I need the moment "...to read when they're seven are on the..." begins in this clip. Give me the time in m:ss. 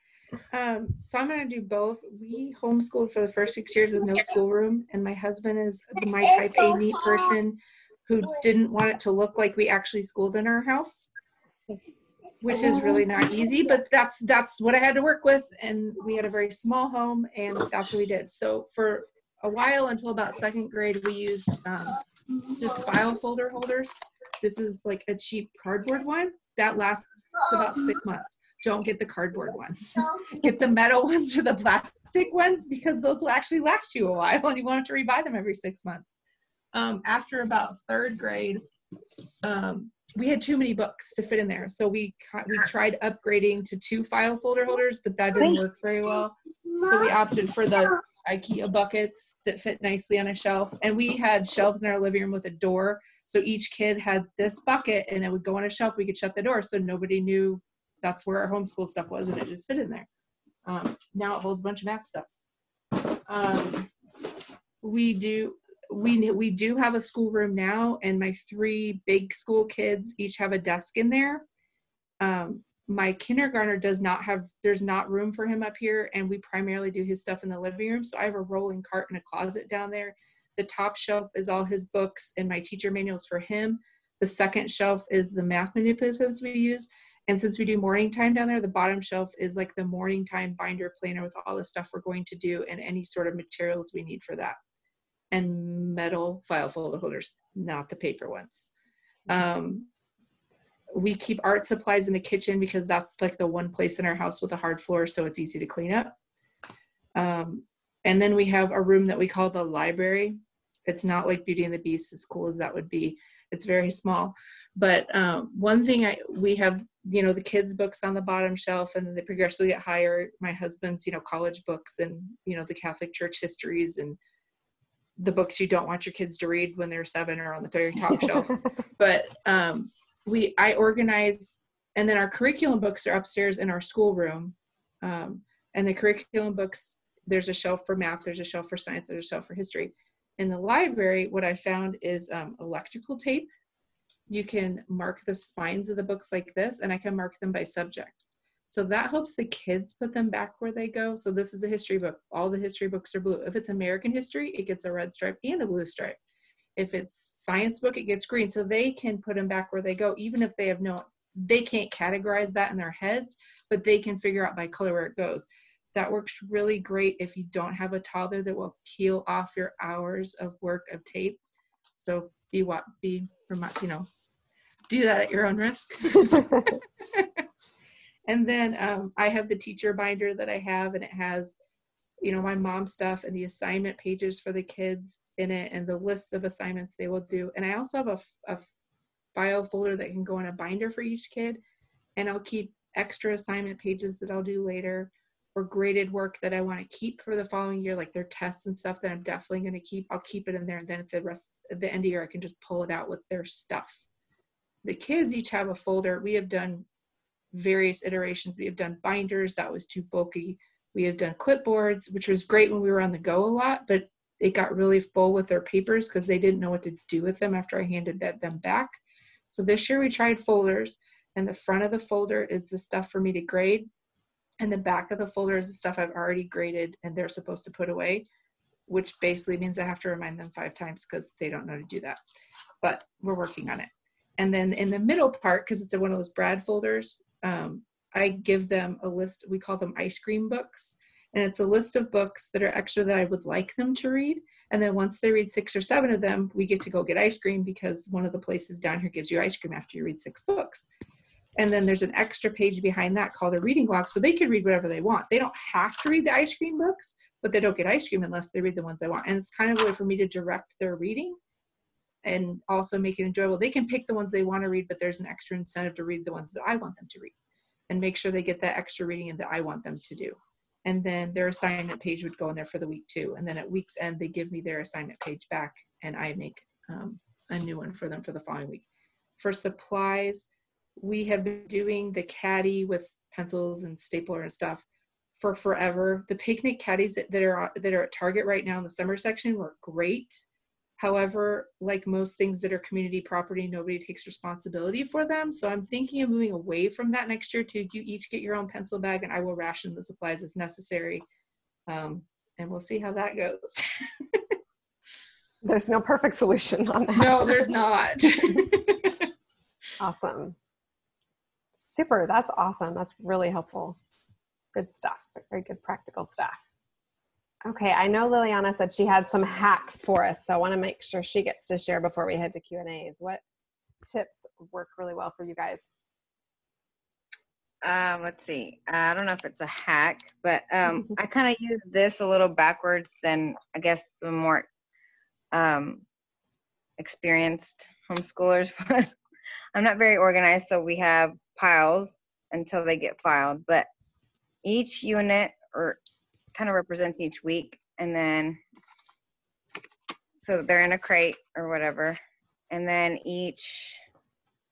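2:06.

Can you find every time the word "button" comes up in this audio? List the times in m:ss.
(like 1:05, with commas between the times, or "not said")
not said.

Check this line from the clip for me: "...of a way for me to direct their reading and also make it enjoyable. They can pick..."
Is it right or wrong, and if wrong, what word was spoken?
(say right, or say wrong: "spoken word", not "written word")
right.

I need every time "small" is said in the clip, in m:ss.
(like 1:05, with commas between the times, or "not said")
0:16, 1:53.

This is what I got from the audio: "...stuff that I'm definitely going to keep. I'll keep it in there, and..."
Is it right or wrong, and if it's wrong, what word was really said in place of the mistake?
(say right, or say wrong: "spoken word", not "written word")
right.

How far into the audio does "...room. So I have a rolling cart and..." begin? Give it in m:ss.
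1:17.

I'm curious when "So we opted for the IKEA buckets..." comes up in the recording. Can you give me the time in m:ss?
0:46.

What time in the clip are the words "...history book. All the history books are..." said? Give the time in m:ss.
2:31.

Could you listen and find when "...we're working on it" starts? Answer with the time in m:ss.
3:53.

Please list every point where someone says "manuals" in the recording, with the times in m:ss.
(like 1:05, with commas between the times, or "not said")
1:22.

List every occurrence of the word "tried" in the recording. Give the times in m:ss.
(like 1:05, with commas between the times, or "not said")
0:42, 3:40.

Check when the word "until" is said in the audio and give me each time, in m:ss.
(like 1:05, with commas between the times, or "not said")
0:19, 5:42.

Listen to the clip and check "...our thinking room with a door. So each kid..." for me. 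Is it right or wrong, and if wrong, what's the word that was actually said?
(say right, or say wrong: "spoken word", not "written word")
wrong: "living", not "thinking".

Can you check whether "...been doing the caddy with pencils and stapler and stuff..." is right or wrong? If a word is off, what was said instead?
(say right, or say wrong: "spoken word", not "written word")
right.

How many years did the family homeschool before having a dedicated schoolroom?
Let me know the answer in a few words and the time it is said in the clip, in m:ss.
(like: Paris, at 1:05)
6, at 0:03.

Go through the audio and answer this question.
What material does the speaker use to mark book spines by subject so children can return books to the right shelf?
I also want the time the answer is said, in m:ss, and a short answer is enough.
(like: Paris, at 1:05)
Electrical tape, at 2:22.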